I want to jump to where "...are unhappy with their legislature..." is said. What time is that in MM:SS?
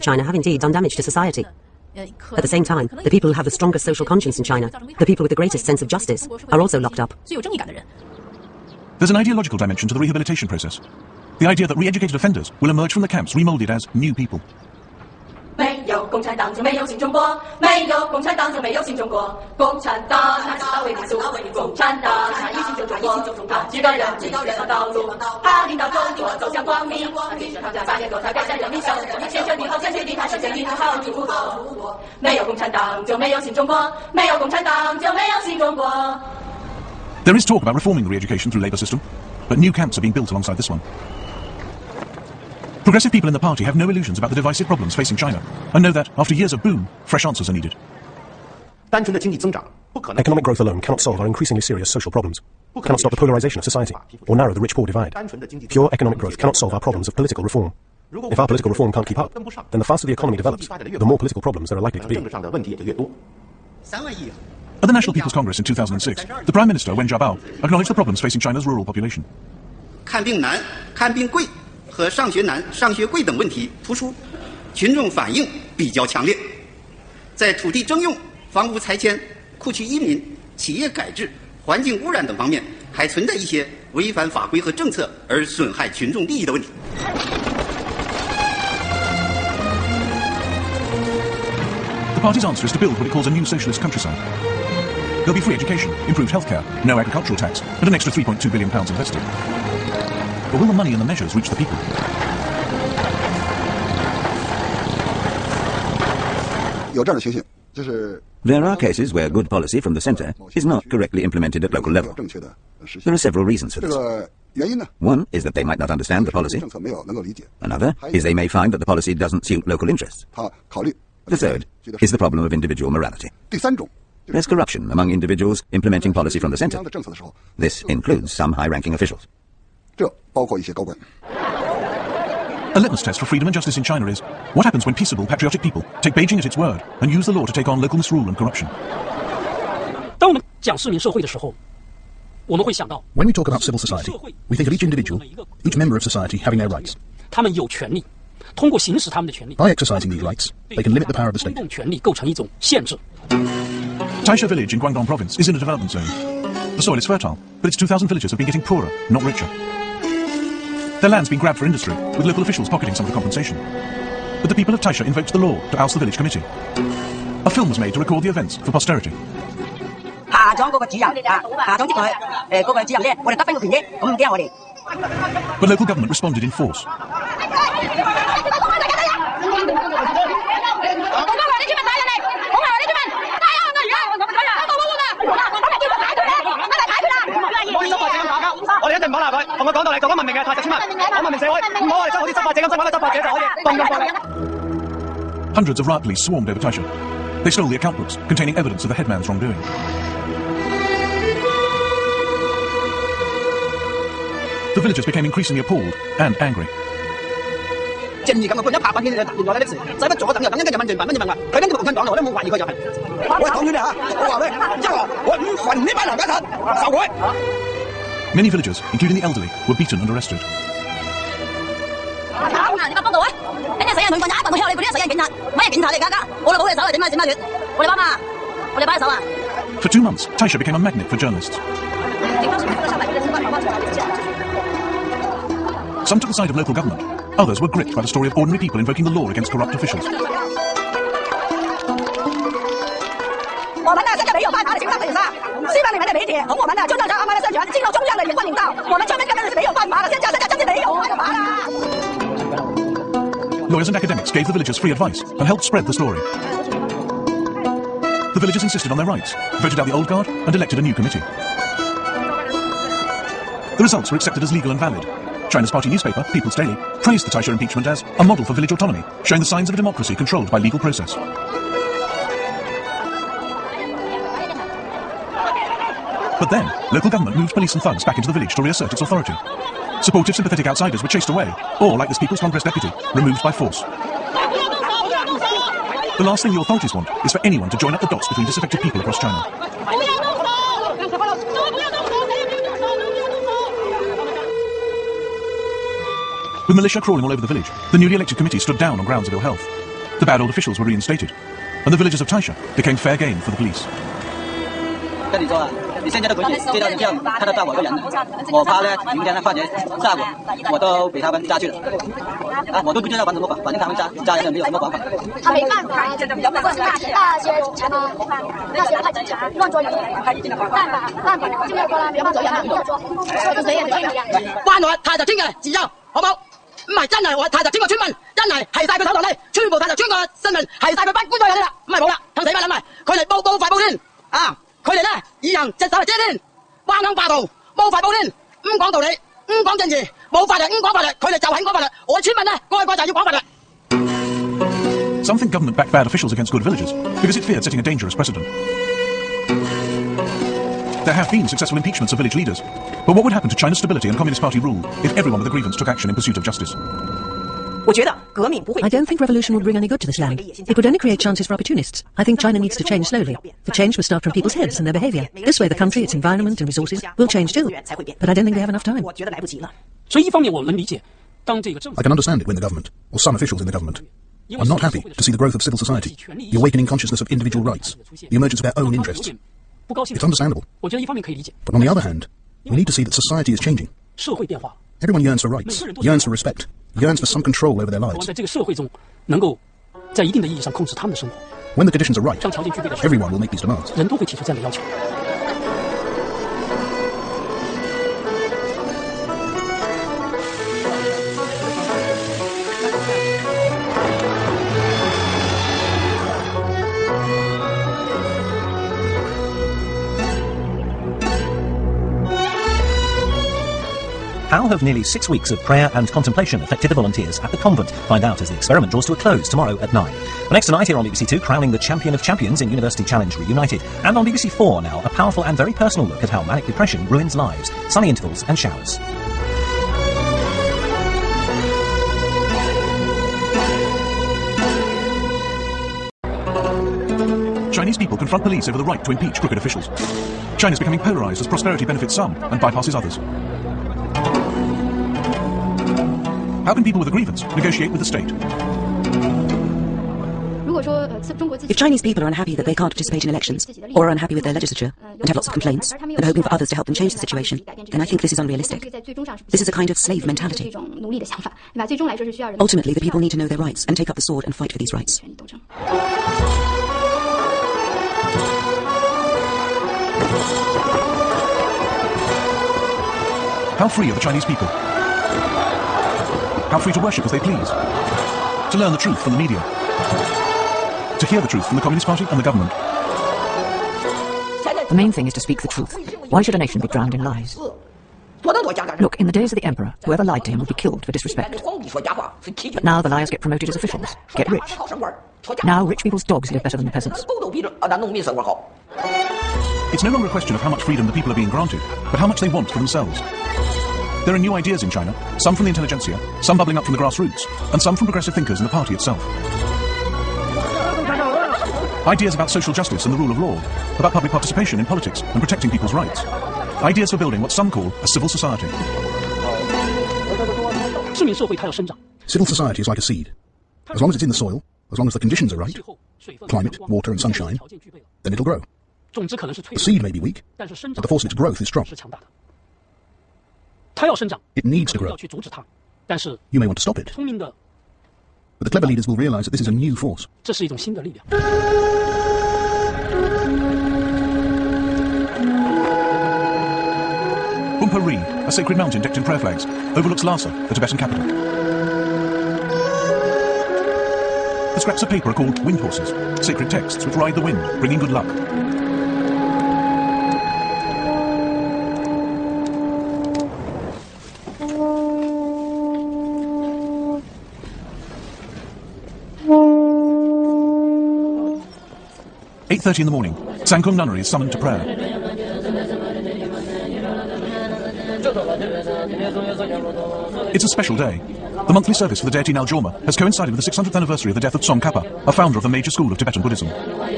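07:34.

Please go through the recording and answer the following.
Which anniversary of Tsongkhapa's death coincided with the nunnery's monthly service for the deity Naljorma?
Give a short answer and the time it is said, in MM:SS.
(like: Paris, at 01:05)
600th, at 09:43.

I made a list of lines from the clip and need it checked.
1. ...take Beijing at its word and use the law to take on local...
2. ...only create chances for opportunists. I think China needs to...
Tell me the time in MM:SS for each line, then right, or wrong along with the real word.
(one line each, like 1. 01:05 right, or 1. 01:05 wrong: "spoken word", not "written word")
1. 02:16 right
2. 06:00 right.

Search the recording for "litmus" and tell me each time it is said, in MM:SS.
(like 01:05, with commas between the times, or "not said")
02:12.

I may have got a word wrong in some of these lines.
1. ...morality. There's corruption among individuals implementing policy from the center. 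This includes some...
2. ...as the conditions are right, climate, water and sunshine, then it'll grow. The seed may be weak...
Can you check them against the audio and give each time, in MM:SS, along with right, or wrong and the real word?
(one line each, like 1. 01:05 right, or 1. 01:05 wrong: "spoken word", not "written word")
1. 02:02 right
2. 08:45 right.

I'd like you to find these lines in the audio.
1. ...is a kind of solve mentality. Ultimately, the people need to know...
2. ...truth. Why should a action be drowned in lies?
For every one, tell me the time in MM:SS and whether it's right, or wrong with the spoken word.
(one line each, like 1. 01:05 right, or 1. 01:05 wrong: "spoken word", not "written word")
1. 07:39 wrong: "slave", not "solve"
2. 08:05 wrong: "nation", not "action".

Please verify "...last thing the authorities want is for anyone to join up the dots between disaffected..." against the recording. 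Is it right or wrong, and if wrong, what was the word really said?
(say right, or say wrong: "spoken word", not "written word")
right.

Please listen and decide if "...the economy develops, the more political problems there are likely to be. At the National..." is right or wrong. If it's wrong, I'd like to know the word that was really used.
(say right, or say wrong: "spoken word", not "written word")
right.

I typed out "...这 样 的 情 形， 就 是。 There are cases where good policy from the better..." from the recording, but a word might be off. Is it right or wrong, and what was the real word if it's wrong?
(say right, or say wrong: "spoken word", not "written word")
wrong: "center", not "better".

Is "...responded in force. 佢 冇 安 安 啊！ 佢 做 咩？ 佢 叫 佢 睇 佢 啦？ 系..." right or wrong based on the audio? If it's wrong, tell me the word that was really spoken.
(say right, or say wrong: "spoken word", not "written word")
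right.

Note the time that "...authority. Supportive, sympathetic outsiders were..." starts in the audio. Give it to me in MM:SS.
04:39.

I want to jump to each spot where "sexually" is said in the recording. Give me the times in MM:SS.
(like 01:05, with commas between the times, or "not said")
not said.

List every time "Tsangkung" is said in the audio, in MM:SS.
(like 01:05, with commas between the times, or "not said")
09:33.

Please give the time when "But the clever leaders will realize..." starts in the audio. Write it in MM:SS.
08:58.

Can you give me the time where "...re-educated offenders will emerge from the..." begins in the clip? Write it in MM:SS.
00:11.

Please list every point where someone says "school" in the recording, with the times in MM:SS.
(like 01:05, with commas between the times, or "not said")
09:45.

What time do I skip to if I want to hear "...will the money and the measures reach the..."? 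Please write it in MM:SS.
01:40.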